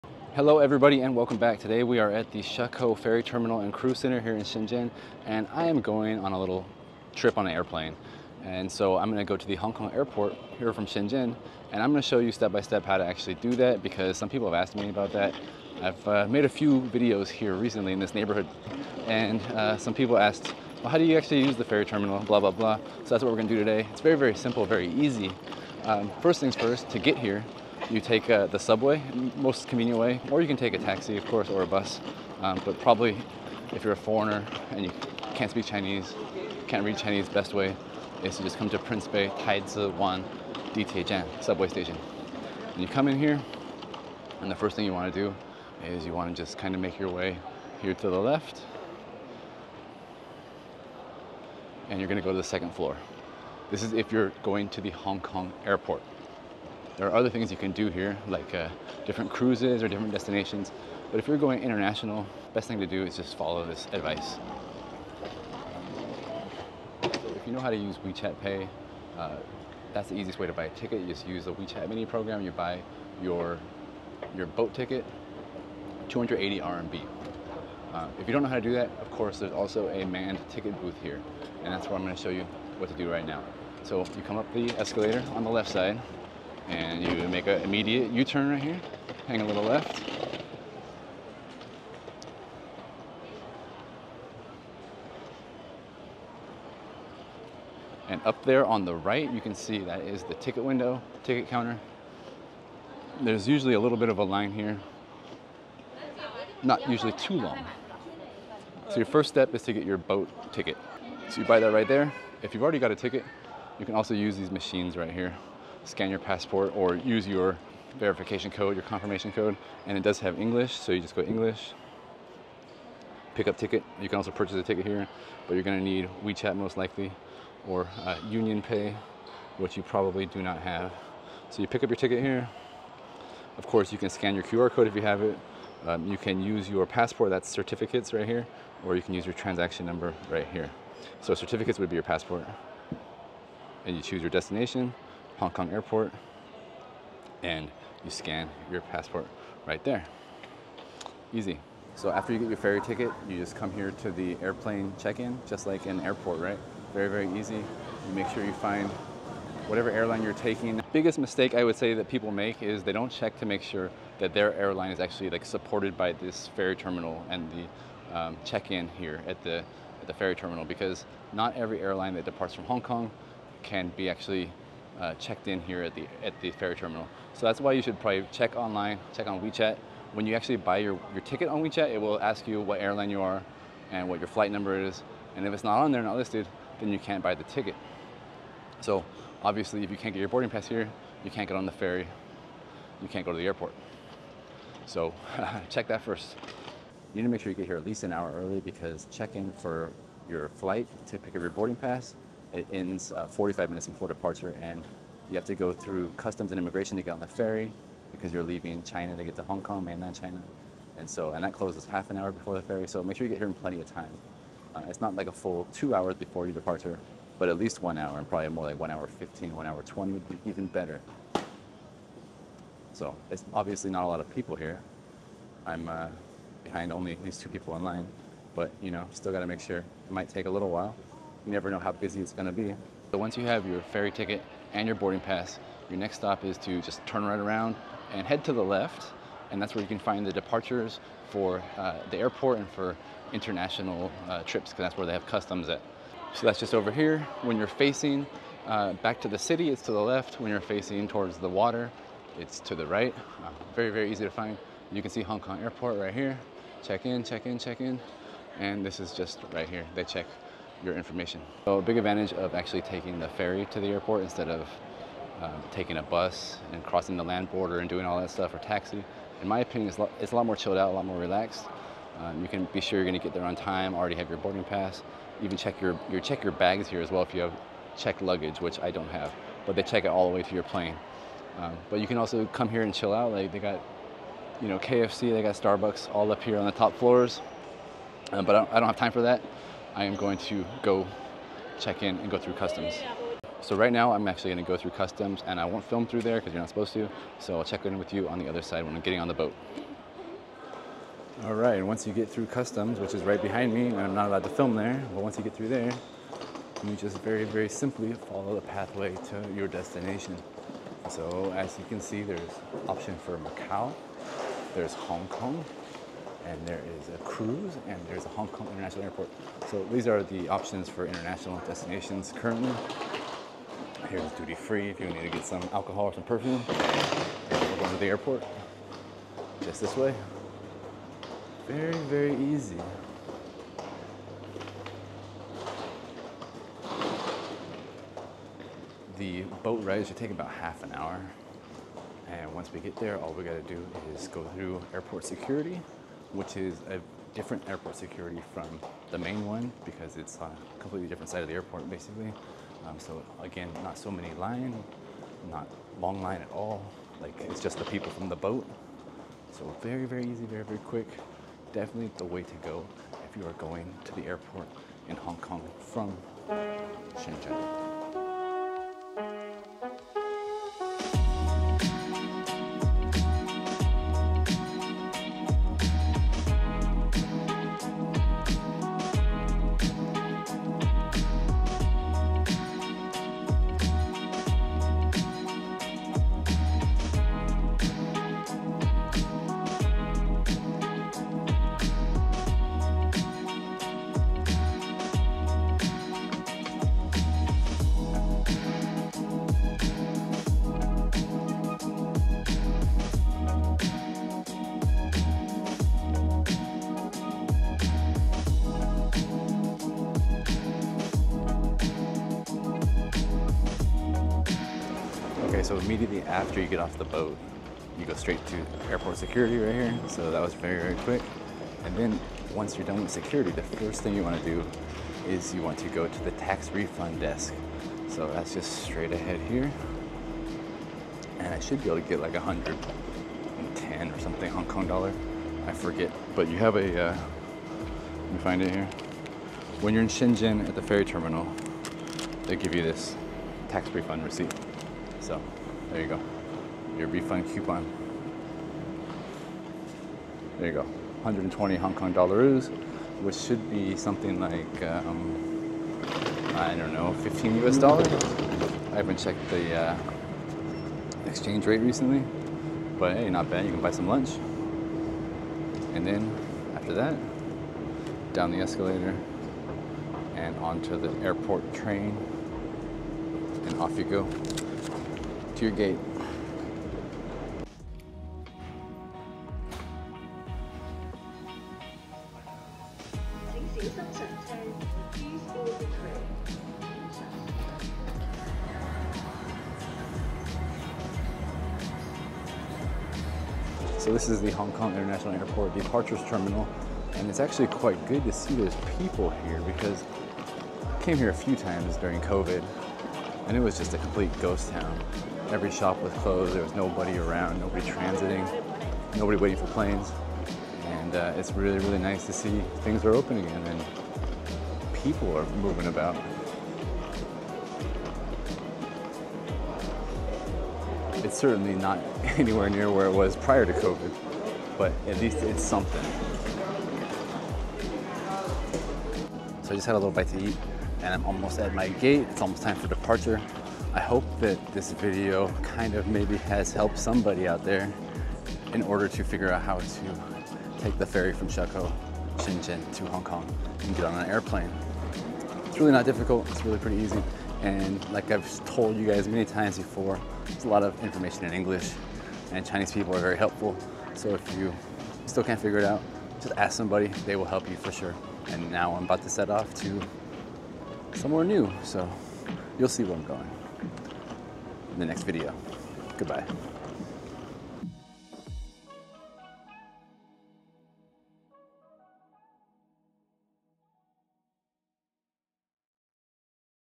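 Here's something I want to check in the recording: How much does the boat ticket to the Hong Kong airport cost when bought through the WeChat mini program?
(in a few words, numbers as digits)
280 RMB.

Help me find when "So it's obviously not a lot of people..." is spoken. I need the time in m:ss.
3:42.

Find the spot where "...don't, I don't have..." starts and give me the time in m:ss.
4:48.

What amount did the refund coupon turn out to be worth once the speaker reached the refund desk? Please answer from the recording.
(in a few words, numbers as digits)
120 Hong Kong dollars.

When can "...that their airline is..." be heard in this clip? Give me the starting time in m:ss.
2:44.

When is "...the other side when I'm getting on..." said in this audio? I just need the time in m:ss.
4:58.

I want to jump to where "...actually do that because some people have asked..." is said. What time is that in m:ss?
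0:13.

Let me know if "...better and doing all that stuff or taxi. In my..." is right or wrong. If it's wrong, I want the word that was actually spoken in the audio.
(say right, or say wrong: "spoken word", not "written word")
wrong: "border", not "better".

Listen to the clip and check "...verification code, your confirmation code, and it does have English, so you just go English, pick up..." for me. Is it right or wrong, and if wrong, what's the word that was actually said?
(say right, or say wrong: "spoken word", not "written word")
right.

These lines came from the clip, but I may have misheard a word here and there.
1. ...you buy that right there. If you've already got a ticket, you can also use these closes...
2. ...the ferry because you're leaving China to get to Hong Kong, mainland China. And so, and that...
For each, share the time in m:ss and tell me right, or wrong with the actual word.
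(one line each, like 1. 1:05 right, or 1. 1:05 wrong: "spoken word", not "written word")
1. 1:51 wrong: "machines", not "closes"
2. 3:27 right.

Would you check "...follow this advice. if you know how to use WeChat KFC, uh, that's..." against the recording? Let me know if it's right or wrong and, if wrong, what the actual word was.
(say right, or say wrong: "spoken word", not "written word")
wrong: "Pay", not "KFC".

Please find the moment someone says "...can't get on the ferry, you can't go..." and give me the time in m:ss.
3:11.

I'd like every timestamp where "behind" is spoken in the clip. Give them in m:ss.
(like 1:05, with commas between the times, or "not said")
3:46, 5:03.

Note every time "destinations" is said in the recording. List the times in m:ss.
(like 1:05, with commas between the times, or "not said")
1:00, 2:24, 5:09, 5:21.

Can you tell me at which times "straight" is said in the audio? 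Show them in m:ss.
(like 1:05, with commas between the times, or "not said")
6:58, 7:08.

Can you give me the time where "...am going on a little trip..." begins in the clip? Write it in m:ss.
0:05.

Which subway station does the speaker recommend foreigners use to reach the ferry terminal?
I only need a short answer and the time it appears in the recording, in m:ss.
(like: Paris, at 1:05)
Prince Bay, at 0:38.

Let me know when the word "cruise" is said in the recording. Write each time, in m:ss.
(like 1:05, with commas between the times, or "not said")
0:03, 0:59, 5:17.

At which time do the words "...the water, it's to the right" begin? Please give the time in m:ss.
4:11.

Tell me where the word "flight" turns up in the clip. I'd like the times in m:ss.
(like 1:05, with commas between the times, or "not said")
3:04, 3:20.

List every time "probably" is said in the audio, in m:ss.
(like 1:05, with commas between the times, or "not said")
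0:32, 2:09, 2:57, 3:38.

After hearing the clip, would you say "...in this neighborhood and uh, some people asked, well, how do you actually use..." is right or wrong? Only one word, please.
right.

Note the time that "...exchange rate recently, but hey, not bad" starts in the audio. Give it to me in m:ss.
7:41.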